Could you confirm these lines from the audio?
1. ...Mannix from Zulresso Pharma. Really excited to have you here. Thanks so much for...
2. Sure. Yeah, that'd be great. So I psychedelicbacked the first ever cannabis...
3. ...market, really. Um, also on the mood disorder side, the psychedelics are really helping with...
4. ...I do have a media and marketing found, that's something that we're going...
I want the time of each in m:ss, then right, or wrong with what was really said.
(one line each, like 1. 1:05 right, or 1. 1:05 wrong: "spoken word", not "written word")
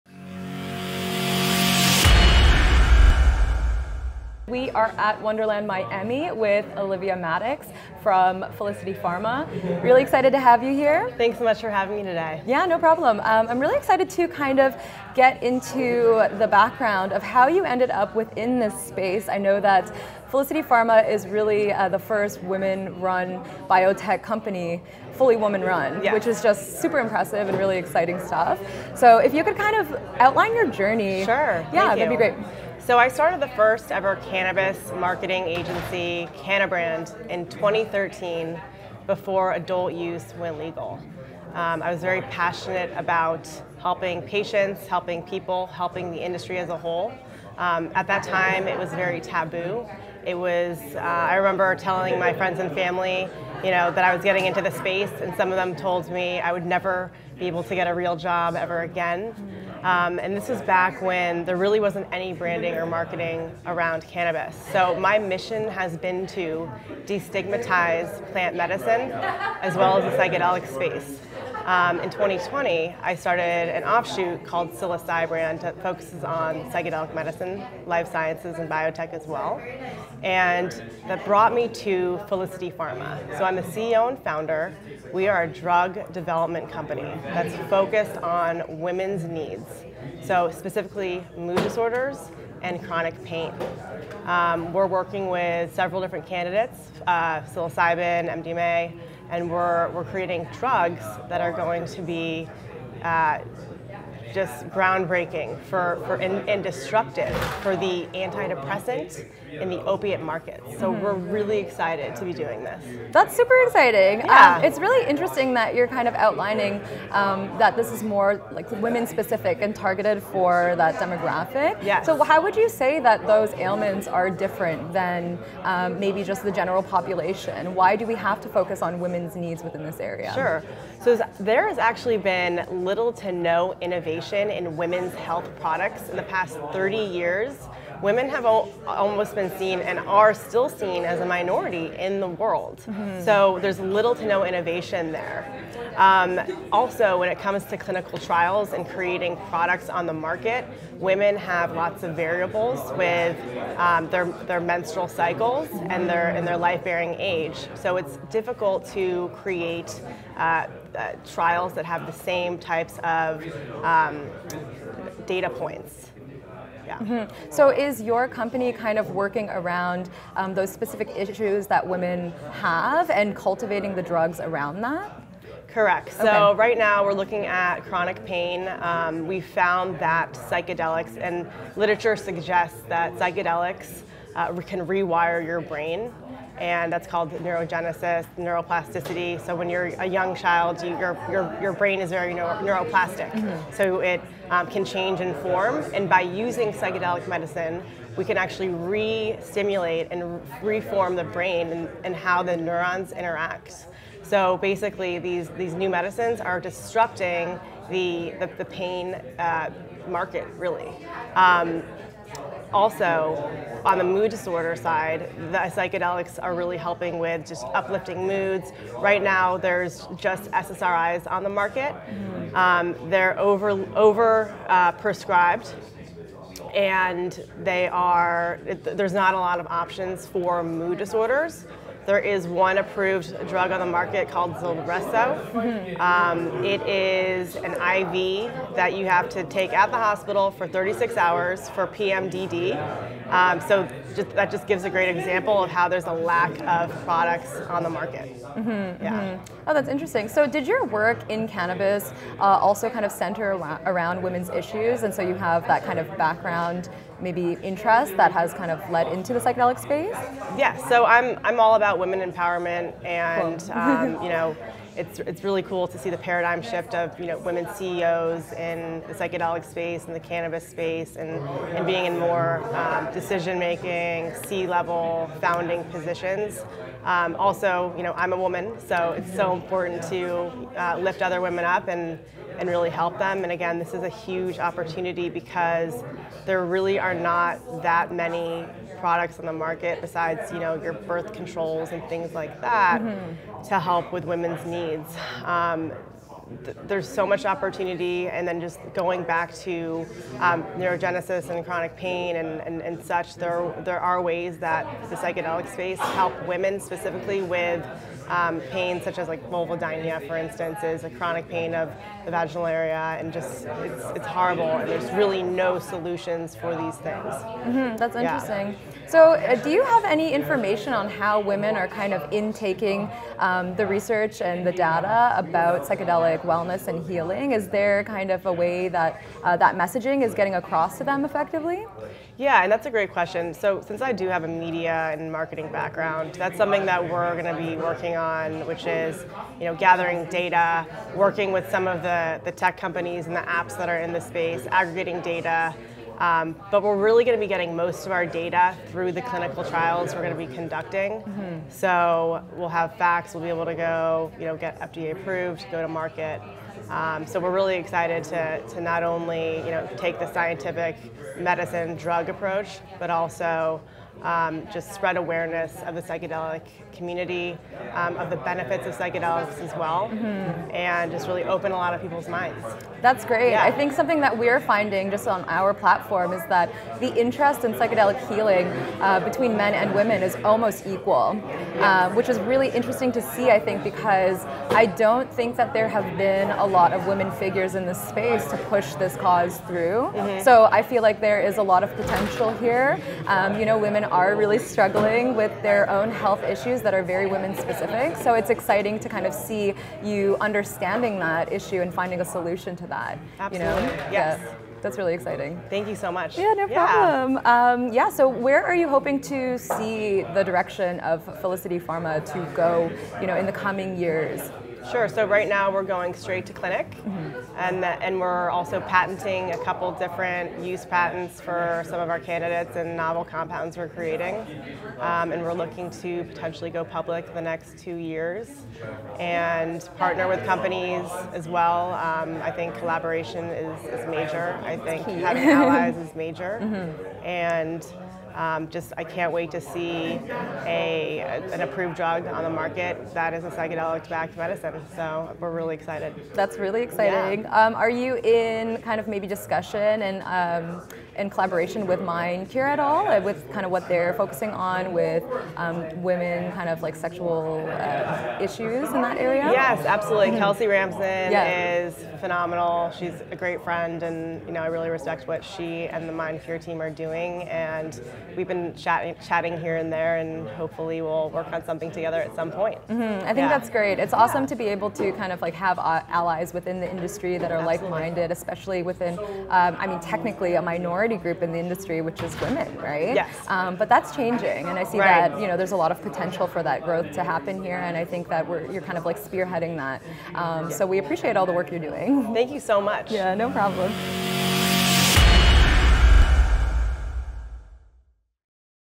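1. 0:07 wrong: "Felicity", not "Zulresso"
2. 0:31 wrong: "started", not "psychedelicbacked"
3. 3:30 right
4. 5:34 wrong: "background", not "found".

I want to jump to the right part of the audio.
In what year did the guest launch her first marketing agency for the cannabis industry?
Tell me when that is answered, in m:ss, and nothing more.
0:37.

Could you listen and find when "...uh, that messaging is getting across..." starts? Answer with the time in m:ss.
5:29.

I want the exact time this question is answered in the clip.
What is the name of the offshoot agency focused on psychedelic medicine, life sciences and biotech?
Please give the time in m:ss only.
1:14.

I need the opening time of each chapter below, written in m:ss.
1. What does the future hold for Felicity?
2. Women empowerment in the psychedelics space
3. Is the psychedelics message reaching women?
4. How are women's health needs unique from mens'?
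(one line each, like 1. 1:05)
1. 6:47
2. 4:09
3. 5:18
4. 1:53.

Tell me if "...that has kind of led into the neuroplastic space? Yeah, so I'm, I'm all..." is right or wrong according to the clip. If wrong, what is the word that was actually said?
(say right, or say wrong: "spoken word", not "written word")
wrong: "psychedelic", not "neuroplastic".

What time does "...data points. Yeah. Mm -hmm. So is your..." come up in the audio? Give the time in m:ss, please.
2:45.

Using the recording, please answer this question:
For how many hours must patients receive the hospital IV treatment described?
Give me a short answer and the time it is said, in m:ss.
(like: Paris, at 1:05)
36, at 4:00.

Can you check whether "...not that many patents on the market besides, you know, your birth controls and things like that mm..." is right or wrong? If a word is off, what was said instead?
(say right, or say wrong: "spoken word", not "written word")
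wrong: "products", not "patents".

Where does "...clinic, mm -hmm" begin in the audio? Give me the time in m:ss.
6:56.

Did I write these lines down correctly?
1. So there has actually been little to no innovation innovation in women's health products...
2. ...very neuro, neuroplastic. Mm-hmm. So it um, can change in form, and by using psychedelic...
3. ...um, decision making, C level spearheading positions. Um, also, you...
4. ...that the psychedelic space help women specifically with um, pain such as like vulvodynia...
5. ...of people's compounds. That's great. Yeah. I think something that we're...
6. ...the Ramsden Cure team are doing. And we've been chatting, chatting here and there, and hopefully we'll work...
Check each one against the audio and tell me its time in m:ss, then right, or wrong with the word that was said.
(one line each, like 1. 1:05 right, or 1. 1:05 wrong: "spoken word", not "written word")
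1. 2:11 right
2. 3:12 right
3. 4:32 wrong: "founding", not "spearheading"
4. 5:04 right
5. 6:11 wrong: "minds", not "compounds"
6. 7:46 wrong: "Mind", not "Ramsden".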